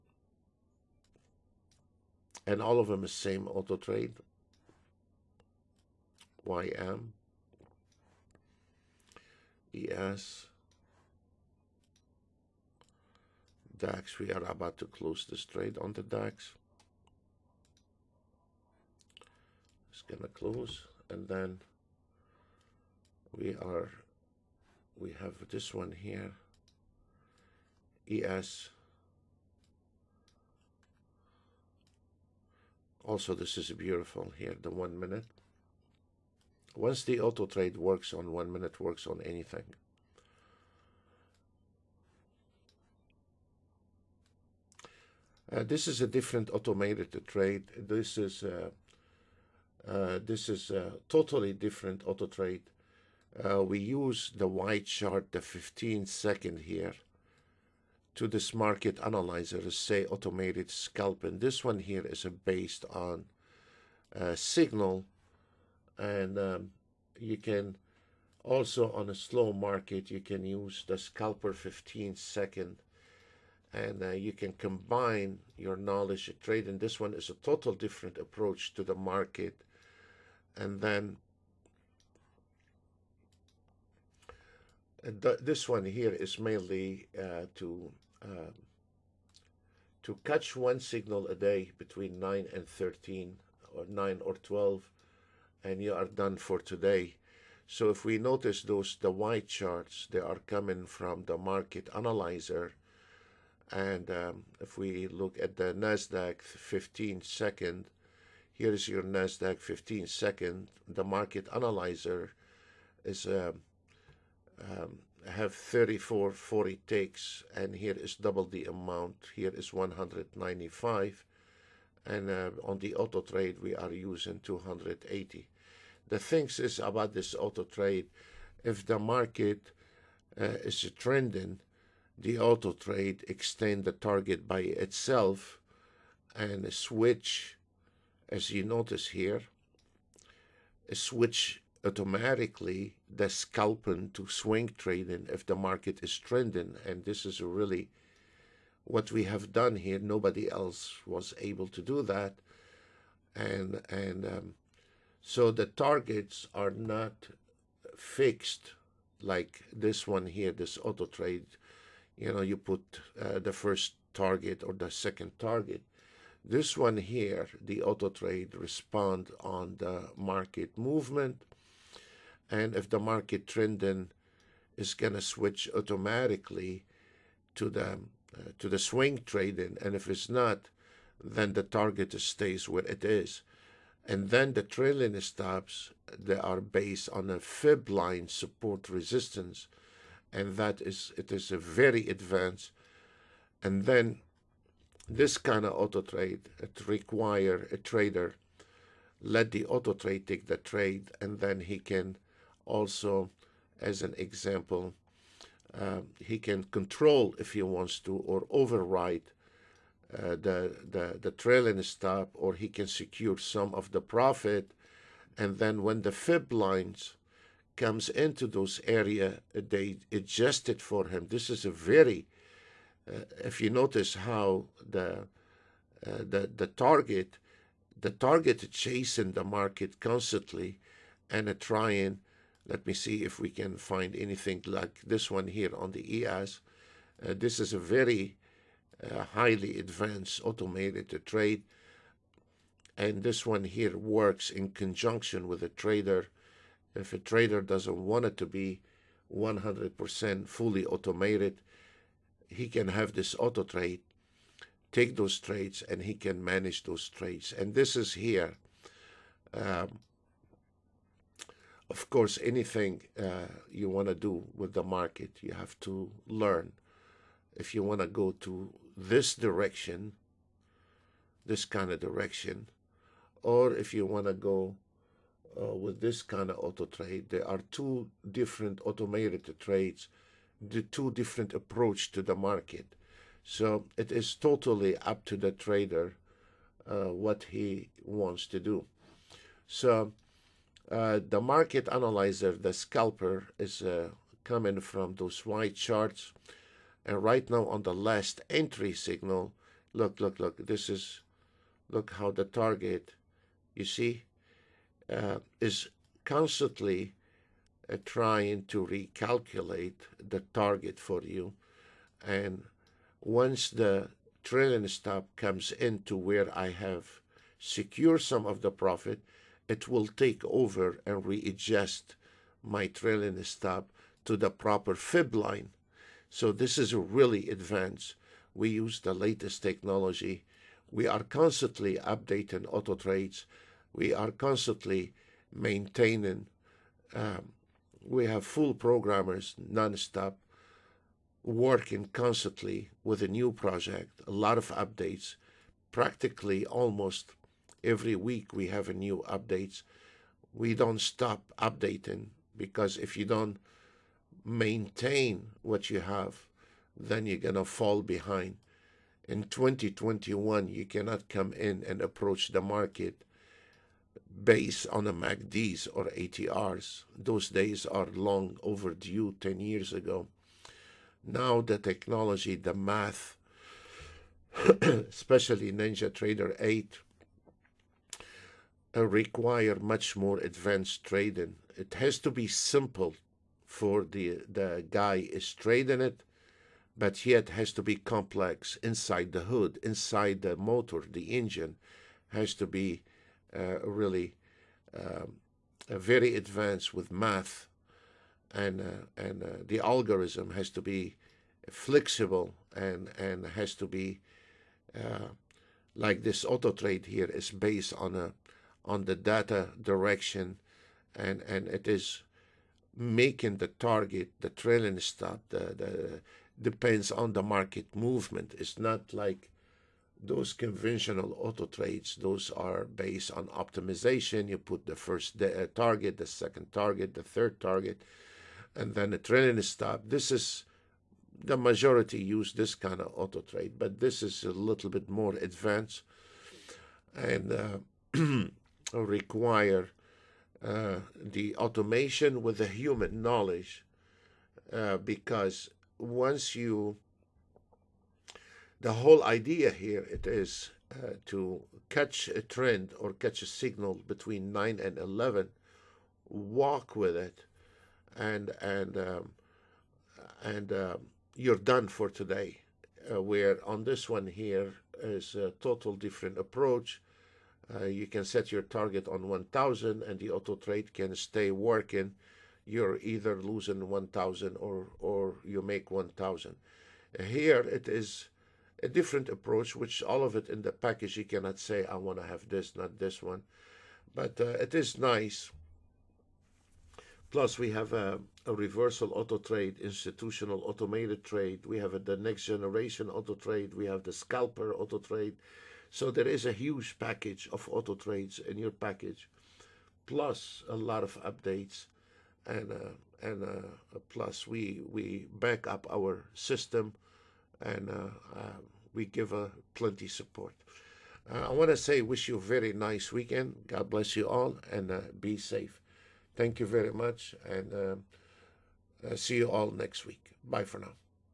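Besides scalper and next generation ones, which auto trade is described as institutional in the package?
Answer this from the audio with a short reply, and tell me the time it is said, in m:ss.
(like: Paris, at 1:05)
Reversal auto trade, at 8:08.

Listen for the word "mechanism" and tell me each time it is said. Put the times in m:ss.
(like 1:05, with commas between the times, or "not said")
not said.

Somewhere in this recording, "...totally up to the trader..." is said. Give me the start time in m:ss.
4:44.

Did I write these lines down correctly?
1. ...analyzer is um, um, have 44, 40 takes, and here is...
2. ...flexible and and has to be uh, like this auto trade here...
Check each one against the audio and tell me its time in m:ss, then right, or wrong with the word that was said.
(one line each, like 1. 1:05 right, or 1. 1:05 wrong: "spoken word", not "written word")
1. 1:51 wrong: "34", not "44"
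2. 6:41 right.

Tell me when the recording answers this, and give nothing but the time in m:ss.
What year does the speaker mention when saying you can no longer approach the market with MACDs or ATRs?
5:59.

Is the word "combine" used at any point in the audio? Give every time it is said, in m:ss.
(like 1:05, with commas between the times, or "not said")
1:14.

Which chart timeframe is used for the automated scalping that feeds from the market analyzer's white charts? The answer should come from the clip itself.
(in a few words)
15 second.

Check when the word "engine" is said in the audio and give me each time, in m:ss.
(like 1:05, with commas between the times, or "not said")
6:31.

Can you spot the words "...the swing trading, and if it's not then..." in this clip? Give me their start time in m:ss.
2:58.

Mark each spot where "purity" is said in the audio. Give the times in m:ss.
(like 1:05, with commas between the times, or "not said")
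not said.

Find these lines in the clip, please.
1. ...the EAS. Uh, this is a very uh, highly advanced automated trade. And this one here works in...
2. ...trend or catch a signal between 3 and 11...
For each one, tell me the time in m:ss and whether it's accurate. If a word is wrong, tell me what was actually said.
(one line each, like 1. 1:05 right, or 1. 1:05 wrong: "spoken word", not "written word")
1. 3:55 right
2. 7:32 wrong: "9", not "3".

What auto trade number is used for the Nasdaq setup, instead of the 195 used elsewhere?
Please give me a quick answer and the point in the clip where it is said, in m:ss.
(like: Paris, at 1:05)
280, at 2:04.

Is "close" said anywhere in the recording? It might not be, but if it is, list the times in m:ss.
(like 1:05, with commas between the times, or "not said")
0:14, 0:20.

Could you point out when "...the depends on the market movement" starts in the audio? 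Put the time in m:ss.
6:55.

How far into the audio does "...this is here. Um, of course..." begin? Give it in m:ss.
4:17.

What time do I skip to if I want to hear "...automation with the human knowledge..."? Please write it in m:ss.
7:21.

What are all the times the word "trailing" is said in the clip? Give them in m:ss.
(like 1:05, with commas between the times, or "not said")
3:04, 3:31, 5:14, 5:22, 6:54, 7:09.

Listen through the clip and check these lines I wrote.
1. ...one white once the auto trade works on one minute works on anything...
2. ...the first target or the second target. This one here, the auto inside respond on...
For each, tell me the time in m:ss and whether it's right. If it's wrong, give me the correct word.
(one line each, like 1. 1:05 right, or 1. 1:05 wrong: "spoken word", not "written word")
1. 0:34 wrong: "minute", not "white"
2. 2:43 wrong: "trade", not "inside".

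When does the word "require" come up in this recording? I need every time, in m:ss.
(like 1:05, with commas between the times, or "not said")
3:16, 6:19, 7:18.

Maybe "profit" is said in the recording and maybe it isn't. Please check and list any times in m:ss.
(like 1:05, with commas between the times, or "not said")
3:34, 5:18.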